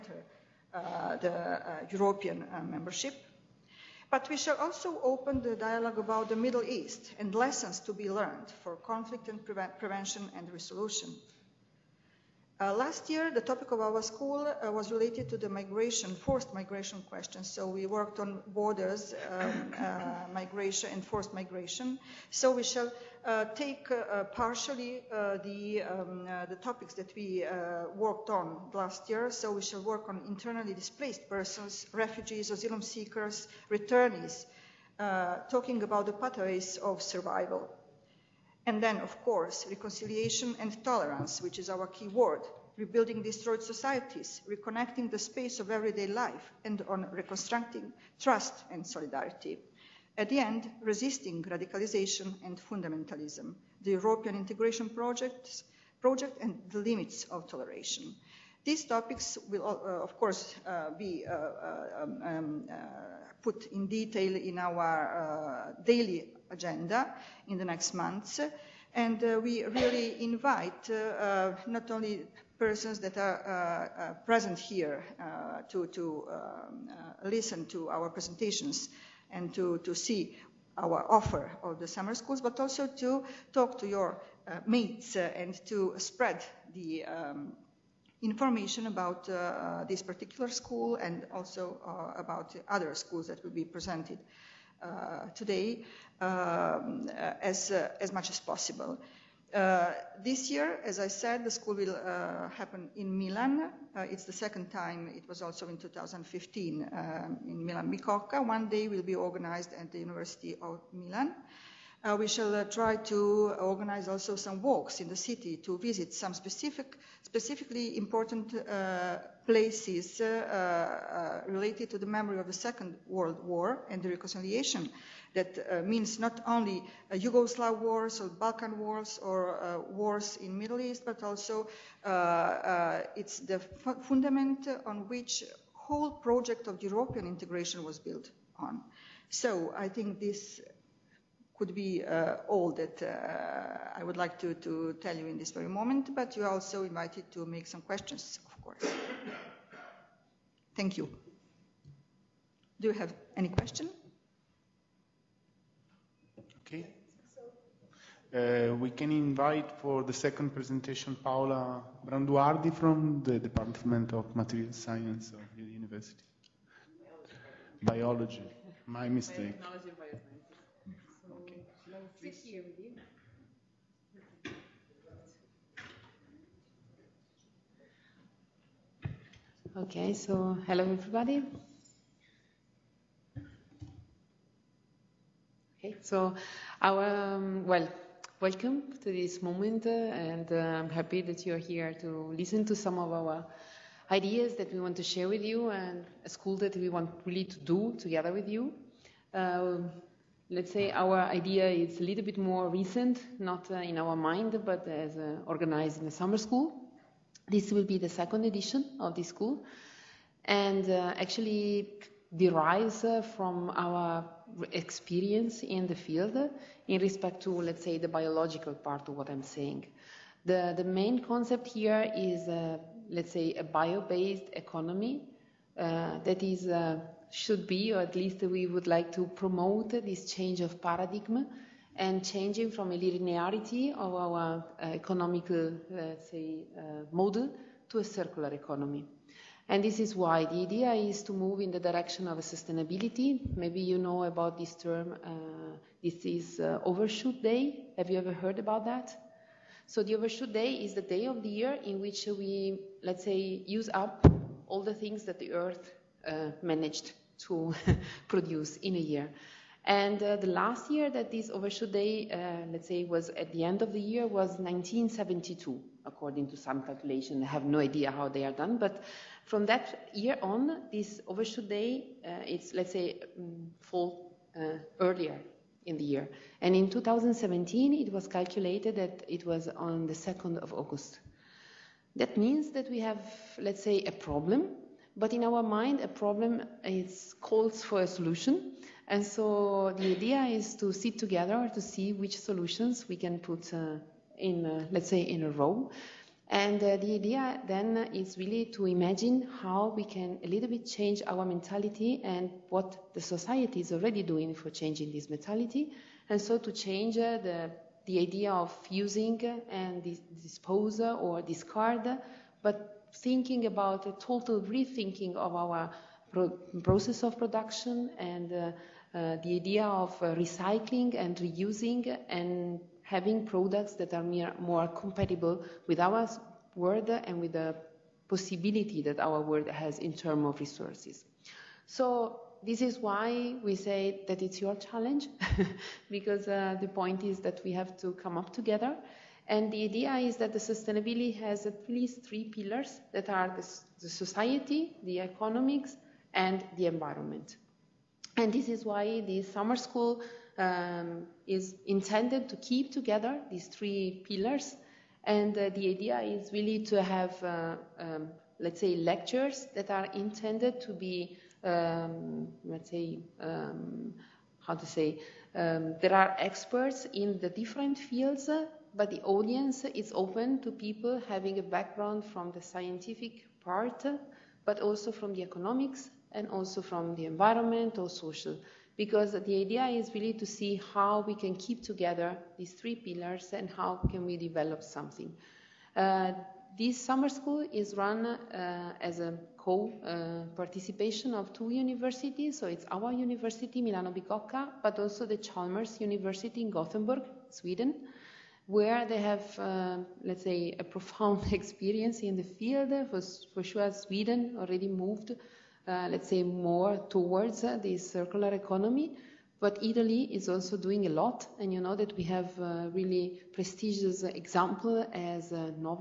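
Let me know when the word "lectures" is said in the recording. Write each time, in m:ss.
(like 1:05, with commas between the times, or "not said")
5:58.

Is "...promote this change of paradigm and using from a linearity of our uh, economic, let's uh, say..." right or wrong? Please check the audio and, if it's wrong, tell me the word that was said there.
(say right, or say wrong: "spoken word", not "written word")
wrong: "changing", not "using".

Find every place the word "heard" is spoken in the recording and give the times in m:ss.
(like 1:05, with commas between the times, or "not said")
4:08.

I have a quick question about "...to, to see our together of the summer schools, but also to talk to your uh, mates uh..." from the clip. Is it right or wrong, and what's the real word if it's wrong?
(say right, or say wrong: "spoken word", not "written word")
wrong: "offer", not "together".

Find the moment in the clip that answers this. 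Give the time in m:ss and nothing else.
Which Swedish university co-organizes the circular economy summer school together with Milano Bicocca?
6:35.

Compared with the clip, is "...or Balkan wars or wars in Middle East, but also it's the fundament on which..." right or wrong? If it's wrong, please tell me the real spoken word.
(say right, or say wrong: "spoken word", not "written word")
right.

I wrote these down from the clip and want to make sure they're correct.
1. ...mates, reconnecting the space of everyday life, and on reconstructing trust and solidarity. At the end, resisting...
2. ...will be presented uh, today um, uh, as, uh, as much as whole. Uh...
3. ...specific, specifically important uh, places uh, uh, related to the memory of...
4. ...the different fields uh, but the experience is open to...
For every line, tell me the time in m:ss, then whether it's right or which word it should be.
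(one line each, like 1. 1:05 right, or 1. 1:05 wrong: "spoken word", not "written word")
1. 0:43 wrong: "societies", not "mates"
2. 1:33 wrong: "possible", not "whole"
3. 1:56 right
4. 6:07 wrong: "audience", not "experience".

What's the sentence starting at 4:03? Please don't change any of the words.
Maybe you know about this term.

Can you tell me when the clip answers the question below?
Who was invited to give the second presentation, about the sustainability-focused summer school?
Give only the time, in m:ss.
2:41.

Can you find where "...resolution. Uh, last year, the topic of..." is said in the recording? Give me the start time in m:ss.
0:10.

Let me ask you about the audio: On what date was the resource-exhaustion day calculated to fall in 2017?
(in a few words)
2nd of August.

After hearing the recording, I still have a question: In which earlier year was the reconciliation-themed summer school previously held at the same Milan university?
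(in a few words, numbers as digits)
2015.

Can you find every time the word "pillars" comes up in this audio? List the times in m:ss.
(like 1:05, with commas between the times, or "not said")
5:42, 5:54, 6:22.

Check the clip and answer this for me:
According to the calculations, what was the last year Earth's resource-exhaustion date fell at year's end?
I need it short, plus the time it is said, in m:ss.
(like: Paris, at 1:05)
1972, at 4:24.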